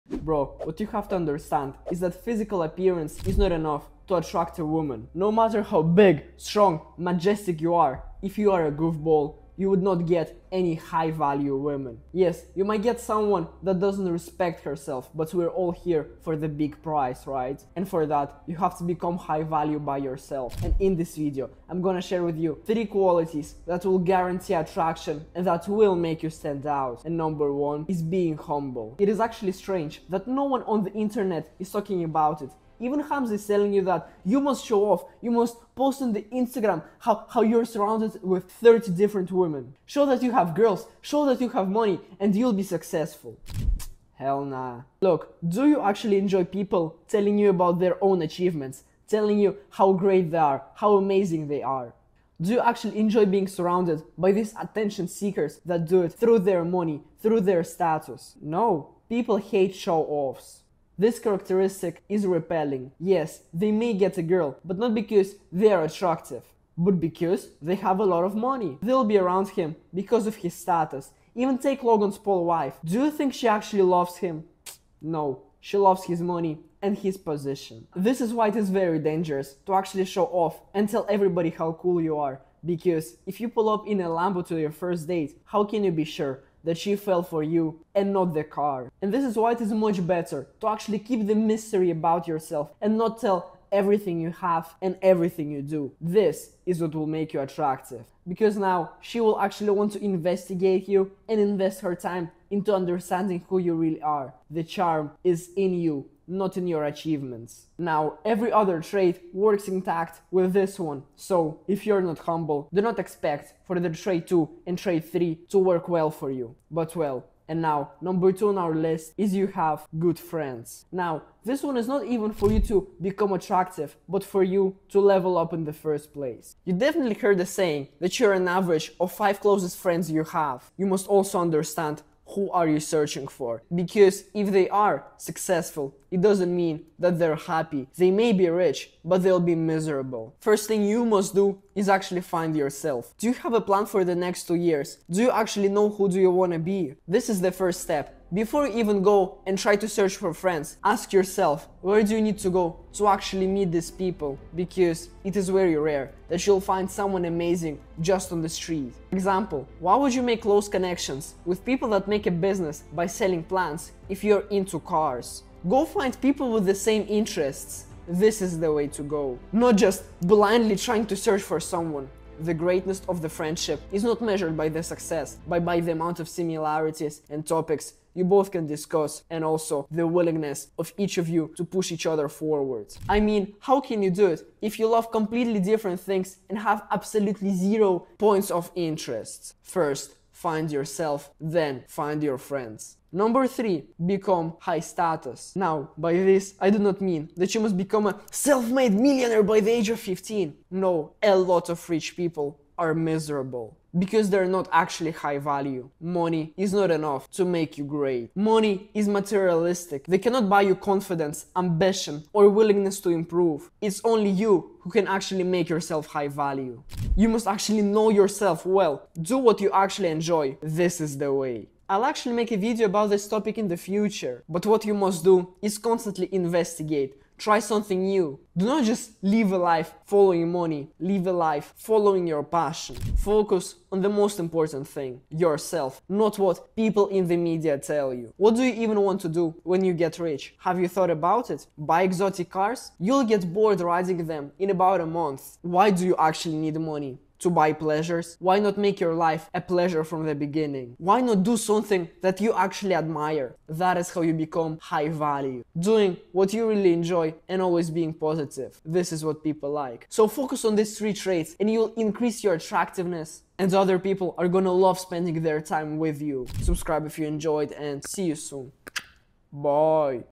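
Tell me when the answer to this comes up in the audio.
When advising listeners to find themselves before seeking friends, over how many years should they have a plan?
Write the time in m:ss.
2:24.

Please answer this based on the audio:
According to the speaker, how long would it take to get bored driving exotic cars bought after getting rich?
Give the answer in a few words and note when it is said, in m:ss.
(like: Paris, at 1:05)
a month, at 4:05.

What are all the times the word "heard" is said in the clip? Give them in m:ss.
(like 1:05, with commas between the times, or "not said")
2:07.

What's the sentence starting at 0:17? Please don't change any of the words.
And for that, you have to become high value by yourself.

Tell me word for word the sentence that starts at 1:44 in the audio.
The charm is in you, not in your achievements.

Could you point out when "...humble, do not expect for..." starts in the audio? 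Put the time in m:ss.
1:52.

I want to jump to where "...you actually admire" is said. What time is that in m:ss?
4:12.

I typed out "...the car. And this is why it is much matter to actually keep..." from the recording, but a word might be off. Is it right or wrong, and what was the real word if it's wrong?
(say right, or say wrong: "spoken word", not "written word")
wrong: "better", not "matter".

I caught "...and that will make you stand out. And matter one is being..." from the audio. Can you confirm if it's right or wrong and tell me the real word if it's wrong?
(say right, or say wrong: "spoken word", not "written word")
wrong: "number", not "matter".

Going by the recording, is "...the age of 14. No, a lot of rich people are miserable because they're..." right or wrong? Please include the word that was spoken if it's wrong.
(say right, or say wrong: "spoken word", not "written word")
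wrong: "15", not "14".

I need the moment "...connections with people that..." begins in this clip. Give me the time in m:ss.
2:40.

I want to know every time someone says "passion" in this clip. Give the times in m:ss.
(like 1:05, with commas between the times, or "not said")
3:52.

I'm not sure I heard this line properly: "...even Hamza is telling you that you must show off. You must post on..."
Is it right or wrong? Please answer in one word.
right.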